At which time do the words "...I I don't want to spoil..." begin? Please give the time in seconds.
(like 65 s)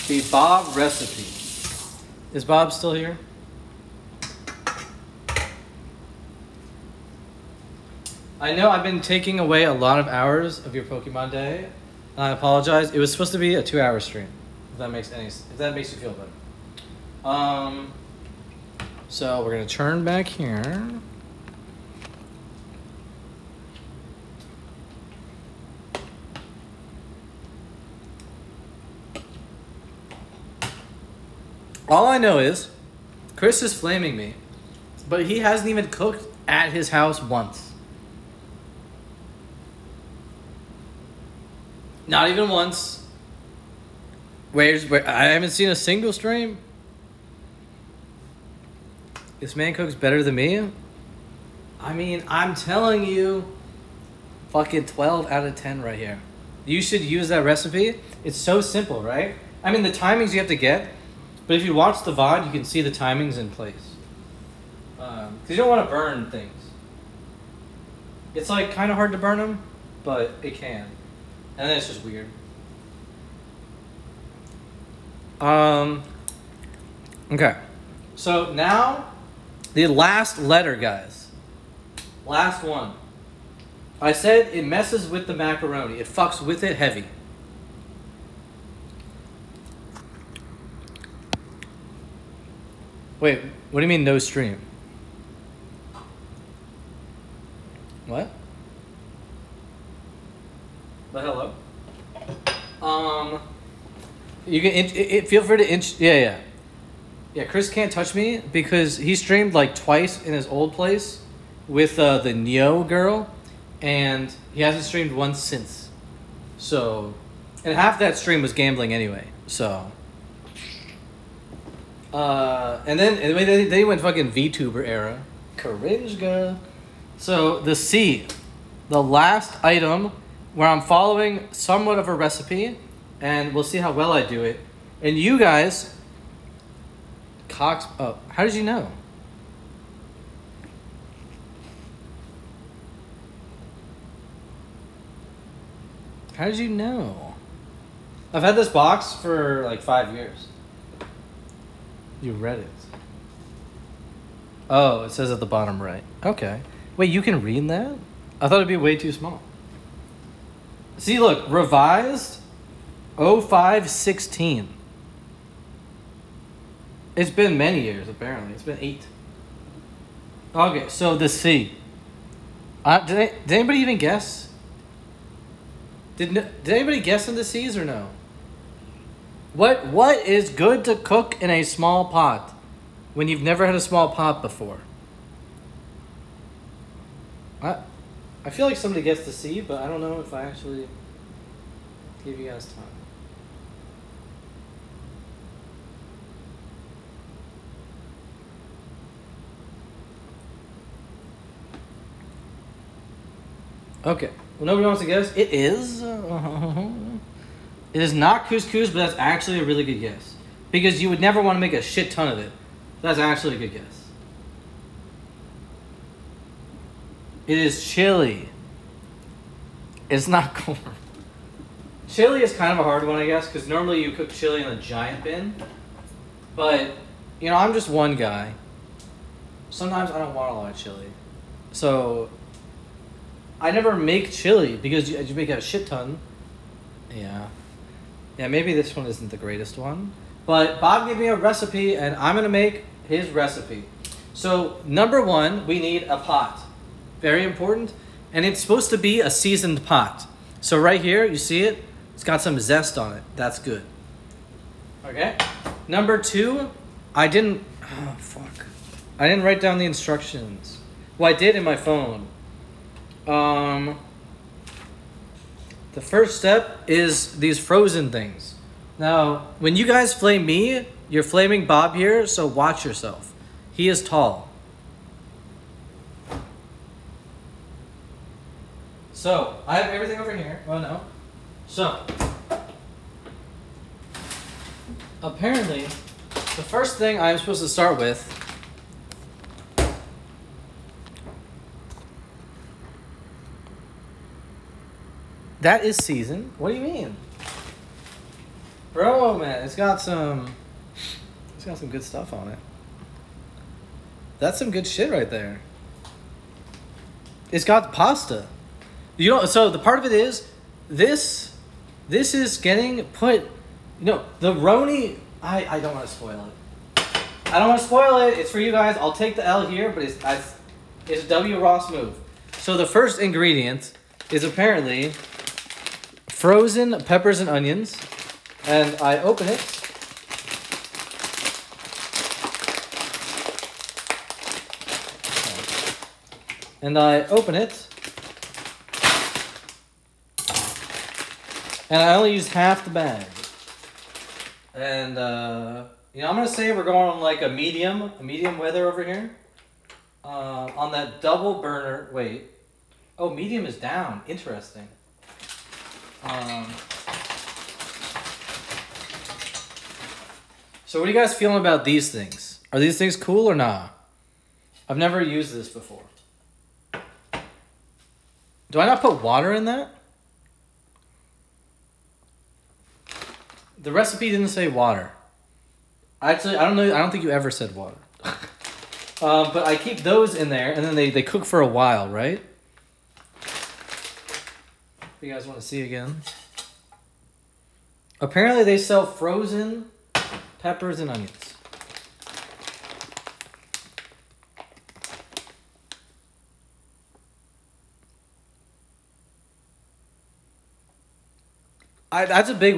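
315 s.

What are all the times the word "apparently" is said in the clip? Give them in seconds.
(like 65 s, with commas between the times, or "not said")
168 s, 285 s, 324 s, 388 s.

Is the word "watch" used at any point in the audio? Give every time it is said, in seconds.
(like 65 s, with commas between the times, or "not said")
61 s, 272 s.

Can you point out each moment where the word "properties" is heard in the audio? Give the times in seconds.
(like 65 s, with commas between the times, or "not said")
not said.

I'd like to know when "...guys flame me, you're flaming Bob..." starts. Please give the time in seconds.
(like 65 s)
269 s.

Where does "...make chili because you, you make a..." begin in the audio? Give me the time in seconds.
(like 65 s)
233 s.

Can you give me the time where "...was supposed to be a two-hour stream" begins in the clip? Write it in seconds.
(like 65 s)
12 s.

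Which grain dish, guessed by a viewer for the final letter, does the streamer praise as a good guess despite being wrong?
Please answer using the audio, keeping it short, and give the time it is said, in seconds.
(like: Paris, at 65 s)
couscous, at 208 s.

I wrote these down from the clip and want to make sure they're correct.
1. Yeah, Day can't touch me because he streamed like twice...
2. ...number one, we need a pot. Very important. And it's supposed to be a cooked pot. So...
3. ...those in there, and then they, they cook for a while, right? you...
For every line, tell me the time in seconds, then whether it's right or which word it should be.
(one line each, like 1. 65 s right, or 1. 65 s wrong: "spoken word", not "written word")
1. 107 s wrong: "Chris", not "Day"
2. 244 s wrong: "seasoned", not "cooked"
3. 379 s right.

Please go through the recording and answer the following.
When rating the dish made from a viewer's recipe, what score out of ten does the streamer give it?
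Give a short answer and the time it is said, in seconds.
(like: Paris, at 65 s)
12, at 54 s.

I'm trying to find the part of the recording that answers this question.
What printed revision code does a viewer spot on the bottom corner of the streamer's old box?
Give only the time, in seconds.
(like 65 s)
163 s.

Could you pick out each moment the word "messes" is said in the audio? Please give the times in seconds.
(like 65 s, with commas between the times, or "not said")
84 s.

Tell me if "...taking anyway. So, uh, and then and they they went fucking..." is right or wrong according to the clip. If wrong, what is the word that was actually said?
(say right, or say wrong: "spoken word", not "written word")
wrong: "gambling", not "taking".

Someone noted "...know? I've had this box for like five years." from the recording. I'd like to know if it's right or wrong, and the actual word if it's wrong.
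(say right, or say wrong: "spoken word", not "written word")
right.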